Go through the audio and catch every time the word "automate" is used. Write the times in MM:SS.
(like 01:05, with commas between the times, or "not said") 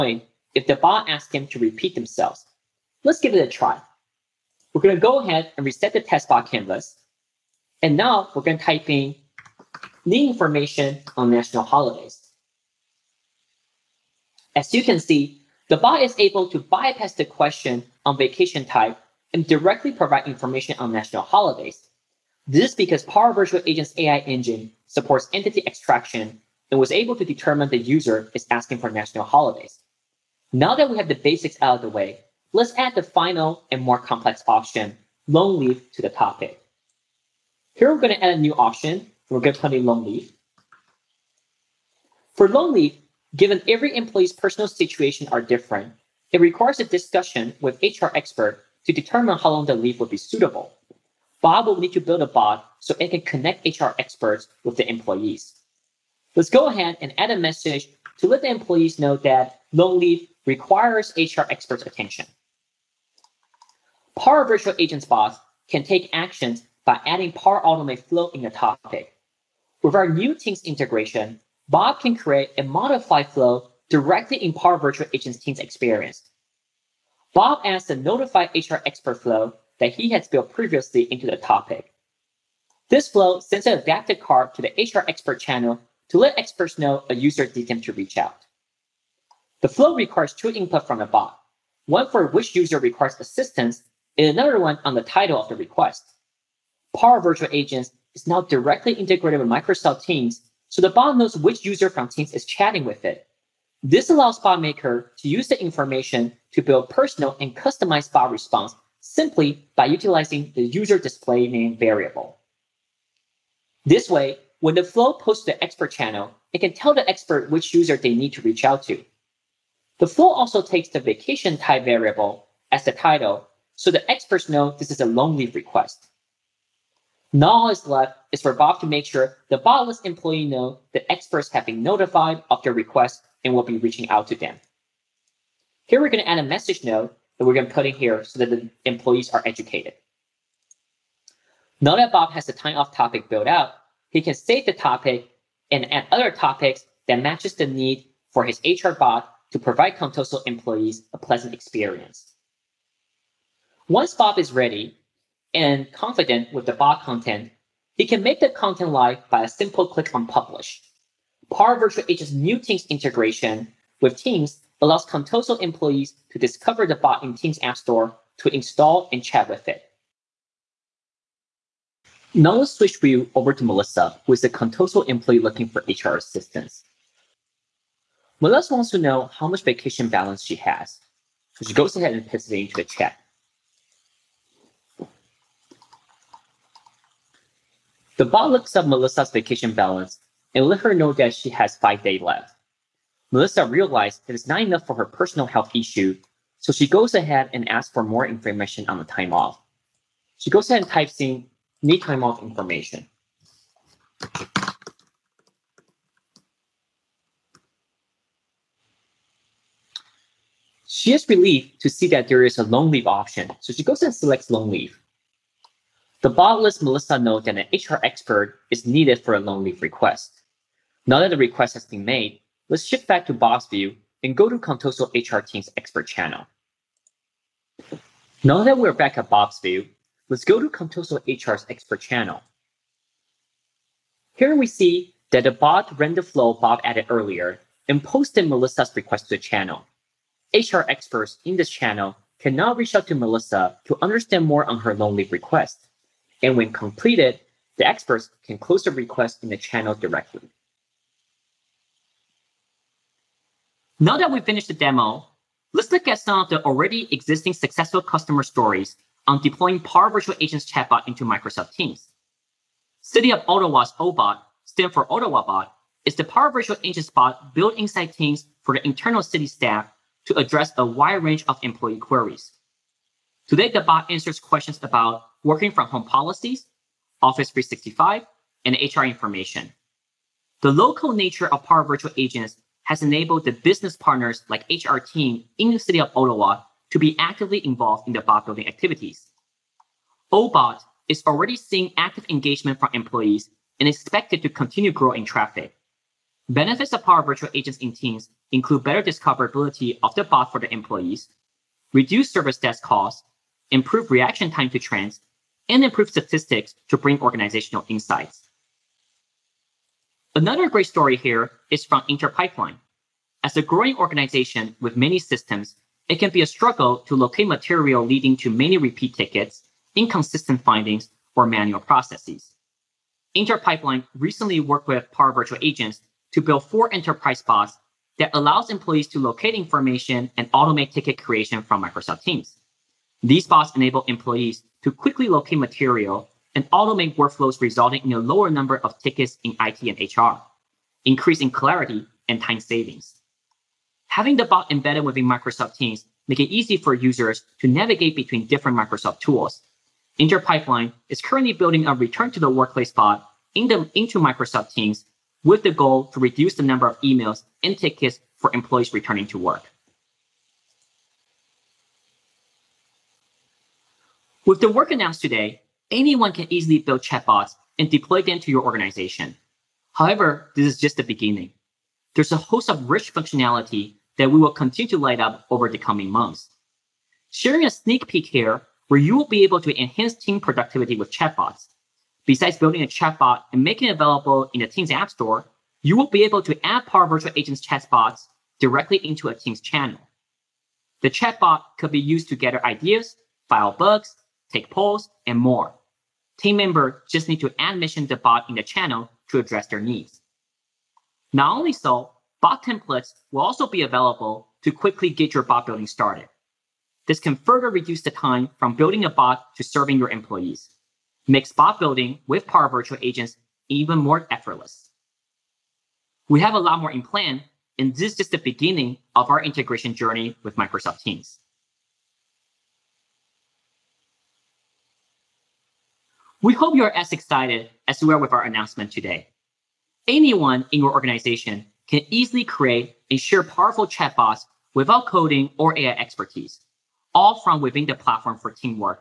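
01:07, 05:30, 05:36.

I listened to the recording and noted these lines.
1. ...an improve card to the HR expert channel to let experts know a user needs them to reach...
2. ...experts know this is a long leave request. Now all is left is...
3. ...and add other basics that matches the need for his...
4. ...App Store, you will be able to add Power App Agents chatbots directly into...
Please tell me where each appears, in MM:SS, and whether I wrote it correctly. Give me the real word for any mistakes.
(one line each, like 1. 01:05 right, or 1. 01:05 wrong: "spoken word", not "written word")
1. 01:23 wrong: "adaptive", not "improve"
2. 02:04 right
3. 02:25 wrong: "topics", not "basics"
4. 06:24 wrong: "Virtual", not "App".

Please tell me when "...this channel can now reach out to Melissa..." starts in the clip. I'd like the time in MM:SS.
04:01.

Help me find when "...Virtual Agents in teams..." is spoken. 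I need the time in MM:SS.
04:57.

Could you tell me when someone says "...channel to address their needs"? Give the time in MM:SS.
06:38.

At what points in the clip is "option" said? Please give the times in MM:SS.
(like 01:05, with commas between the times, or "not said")
00:34, 00:38, 03:33.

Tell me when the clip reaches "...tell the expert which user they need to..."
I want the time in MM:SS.
01:56.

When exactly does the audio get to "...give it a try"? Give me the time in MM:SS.
00:03.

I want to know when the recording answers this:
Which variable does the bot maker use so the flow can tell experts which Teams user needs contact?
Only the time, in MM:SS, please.
01:50.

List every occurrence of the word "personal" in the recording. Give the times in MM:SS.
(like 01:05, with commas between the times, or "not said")
00:44, 01:46, 03:15.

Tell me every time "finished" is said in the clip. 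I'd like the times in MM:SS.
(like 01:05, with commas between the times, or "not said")
04:14.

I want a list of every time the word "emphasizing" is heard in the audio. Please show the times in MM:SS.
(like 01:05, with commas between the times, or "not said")
not said.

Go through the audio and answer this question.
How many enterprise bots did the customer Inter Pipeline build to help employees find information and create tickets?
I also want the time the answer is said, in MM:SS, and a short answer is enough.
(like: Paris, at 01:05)
4, at 05:26.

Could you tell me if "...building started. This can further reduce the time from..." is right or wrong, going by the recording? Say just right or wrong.
right.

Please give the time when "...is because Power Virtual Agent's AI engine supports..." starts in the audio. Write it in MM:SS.
00:22.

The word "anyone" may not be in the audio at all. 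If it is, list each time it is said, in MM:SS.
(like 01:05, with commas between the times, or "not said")
06:05, 07:10.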